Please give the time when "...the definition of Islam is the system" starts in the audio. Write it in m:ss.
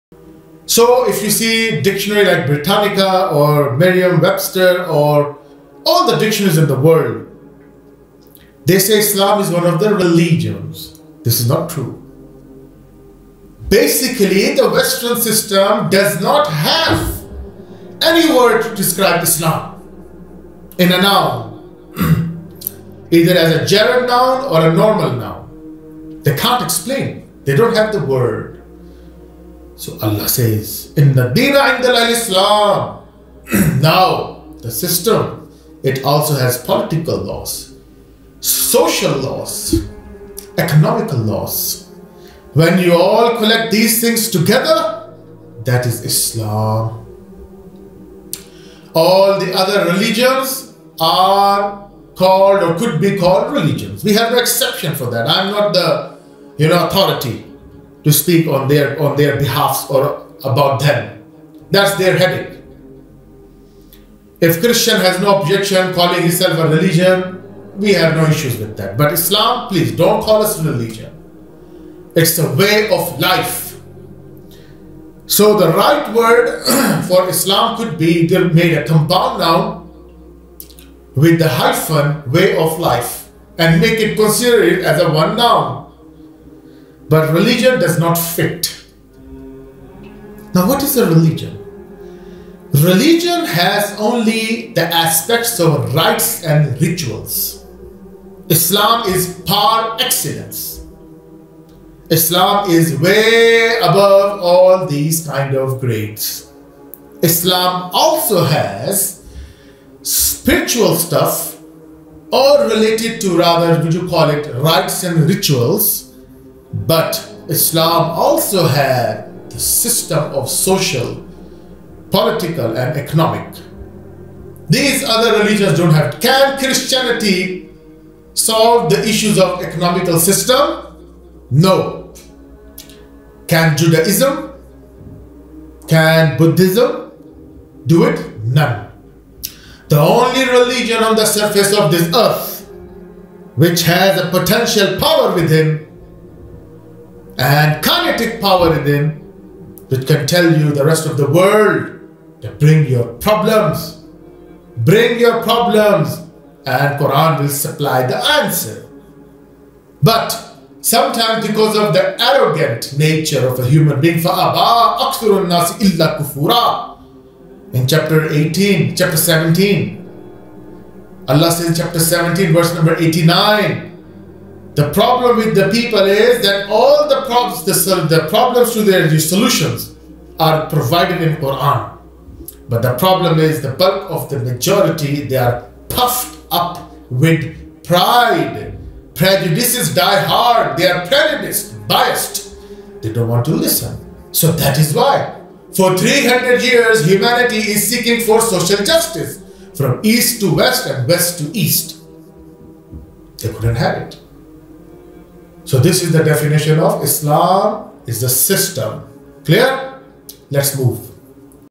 3:26.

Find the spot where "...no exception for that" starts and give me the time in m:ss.
0:54.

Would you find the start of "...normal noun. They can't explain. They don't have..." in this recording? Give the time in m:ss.
0:24.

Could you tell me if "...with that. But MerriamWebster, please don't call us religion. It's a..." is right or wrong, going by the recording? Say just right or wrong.
wrong.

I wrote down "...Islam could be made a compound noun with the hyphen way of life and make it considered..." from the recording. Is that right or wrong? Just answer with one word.
right.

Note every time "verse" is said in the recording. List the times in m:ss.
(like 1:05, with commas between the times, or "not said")
2:52.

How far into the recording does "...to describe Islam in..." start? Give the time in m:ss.
0:18.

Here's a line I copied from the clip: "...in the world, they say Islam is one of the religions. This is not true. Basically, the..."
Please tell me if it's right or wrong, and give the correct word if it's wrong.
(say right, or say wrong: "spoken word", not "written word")
right.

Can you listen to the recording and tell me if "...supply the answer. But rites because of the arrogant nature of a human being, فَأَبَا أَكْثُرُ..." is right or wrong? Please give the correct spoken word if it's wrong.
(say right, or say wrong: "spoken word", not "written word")
wrong: "sometimes", not "rites".